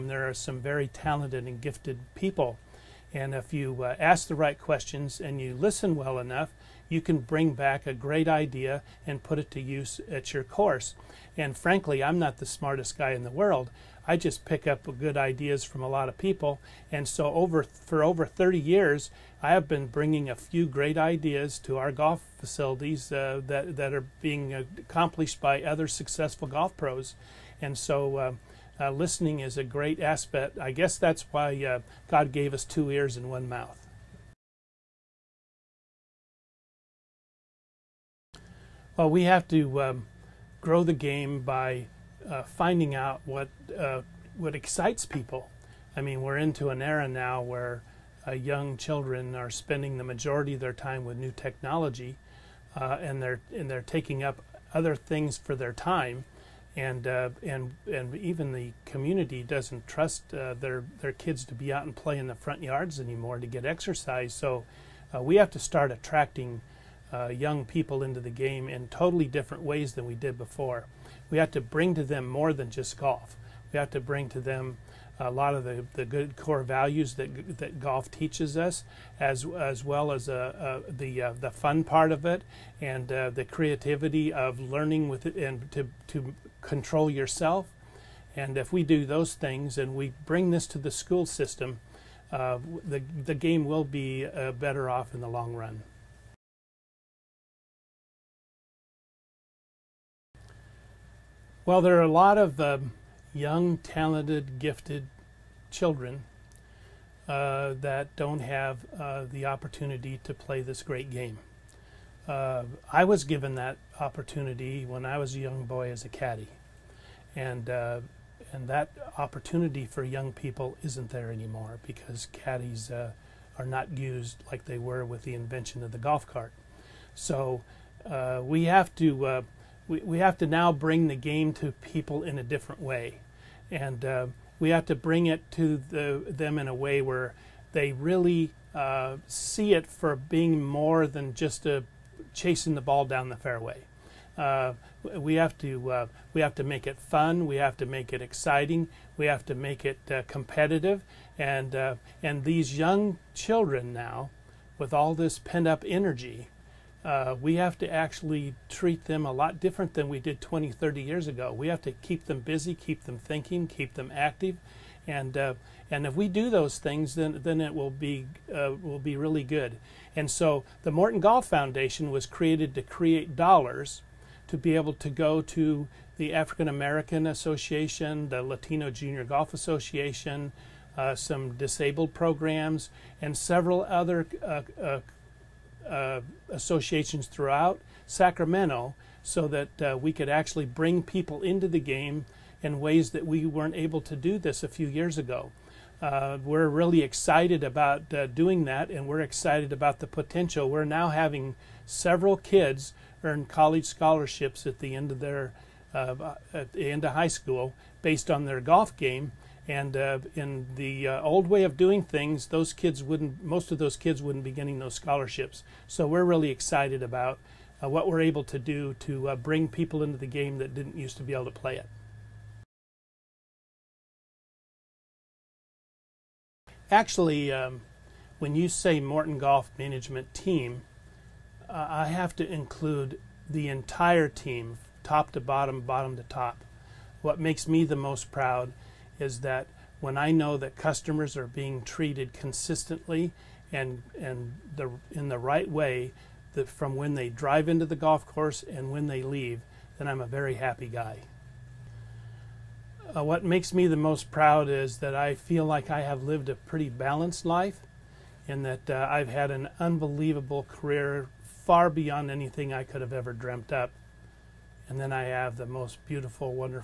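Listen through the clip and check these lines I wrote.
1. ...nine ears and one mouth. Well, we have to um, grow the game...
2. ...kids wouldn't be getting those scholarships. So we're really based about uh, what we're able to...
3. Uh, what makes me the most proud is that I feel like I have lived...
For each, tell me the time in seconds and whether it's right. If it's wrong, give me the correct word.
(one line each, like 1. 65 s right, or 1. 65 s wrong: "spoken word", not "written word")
1. 32 s wrong: "two", not "nine"
2. 213 s wrong: "excited", not "based"
3. 253 s right.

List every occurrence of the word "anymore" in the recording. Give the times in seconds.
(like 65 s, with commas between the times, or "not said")
62 s, 121 s.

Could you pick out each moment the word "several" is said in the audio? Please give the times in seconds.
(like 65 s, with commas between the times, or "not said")
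183 s, 201 s.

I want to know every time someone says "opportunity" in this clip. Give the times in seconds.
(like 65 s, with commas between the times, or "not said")
109 s, 113 s, 119 s.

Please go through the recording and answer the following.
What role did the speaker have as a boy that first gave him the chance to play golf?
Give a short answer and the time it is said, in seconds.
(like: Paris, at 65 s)
Caddy, at 116 s.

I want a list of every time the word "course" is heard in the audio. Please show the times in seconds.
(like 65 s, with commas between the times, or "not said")
10 s, 248 s.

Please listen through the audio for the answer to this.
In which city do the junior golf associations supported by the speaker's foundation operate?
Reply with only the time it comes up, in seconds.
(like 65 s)
188 s.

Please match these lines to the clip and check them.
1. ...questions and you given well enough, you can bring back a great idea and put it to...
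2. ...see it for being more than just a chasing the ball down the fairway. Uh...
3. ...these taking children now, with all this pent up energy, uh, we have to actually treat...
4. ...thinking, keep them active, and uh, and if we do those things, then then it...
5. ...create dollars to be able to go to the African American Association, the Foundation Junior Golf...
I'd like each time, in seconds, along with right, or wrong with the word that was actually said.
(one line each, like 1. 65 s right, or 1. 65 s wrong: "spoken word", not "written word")
1. 4 s wrong: "listen", not "given"
2. 139 s right
3. 152 s wrong: "young", not "taking"
4. 163 s right
5. 172 s wrong: "Latino", not "Foundation".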